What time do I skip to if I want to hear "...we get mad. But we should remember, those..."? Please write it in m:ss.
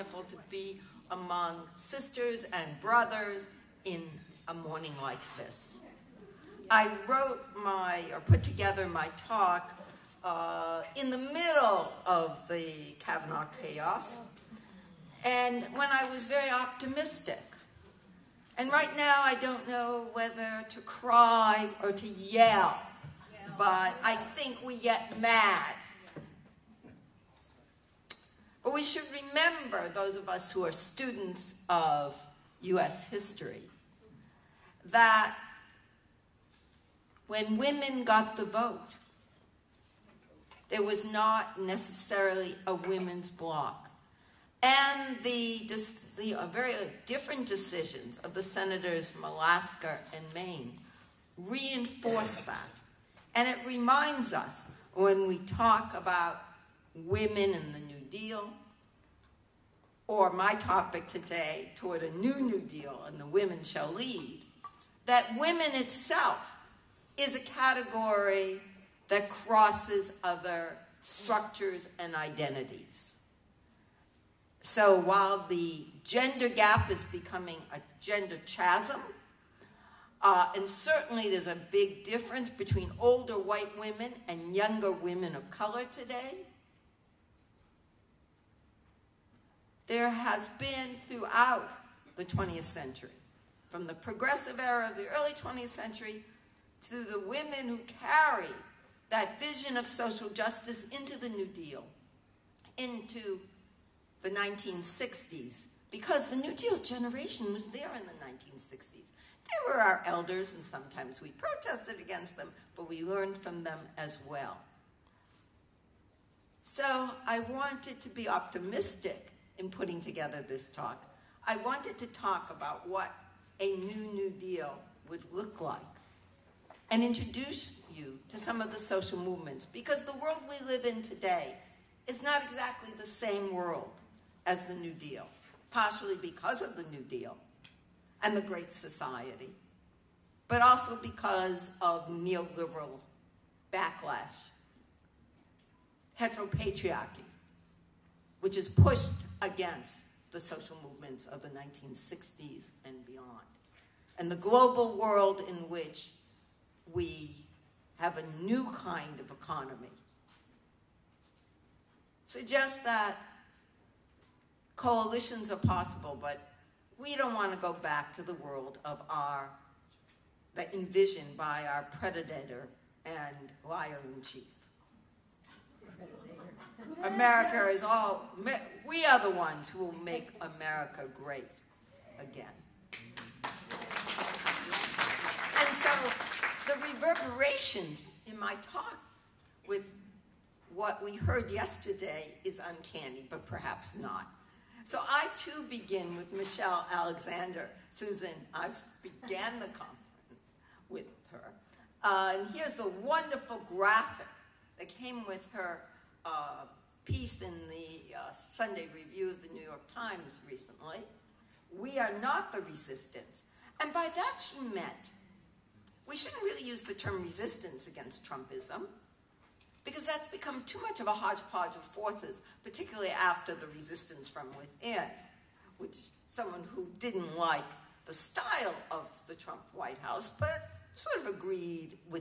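0:24.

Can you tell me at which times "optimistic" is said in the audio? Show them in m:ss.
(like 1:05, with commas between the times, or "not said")
0:16, 1:58.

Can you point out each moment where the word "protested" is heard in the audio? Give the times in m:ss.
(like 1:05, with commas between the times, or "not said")
1:51.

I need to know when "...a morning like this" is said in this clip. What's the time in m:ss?
0:04.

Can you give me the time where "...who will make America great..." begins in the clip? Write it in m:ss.
2:59.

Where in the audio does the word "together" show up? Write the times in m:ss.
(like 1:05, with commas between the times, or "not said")
0:08, 1:59.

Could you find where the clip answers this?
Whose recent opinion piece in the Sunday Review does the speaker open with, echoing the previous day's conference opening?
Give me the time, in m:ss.
3:16.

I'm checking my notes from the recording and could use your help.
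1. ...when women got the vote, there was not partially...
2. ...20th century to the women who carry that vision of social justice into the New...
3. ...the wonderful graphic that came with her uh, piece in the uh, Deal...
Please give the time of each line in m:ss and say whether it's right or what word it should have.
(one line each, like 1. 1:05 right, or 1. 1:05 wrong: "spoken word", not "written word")
1. 0:37 wrong: "necessarily", not "partially"
2. 1:35 right
3. 3:22 wrong: "Sunday", not "Deal".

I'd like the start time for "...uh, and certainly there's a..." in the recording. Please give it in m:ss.
1:20.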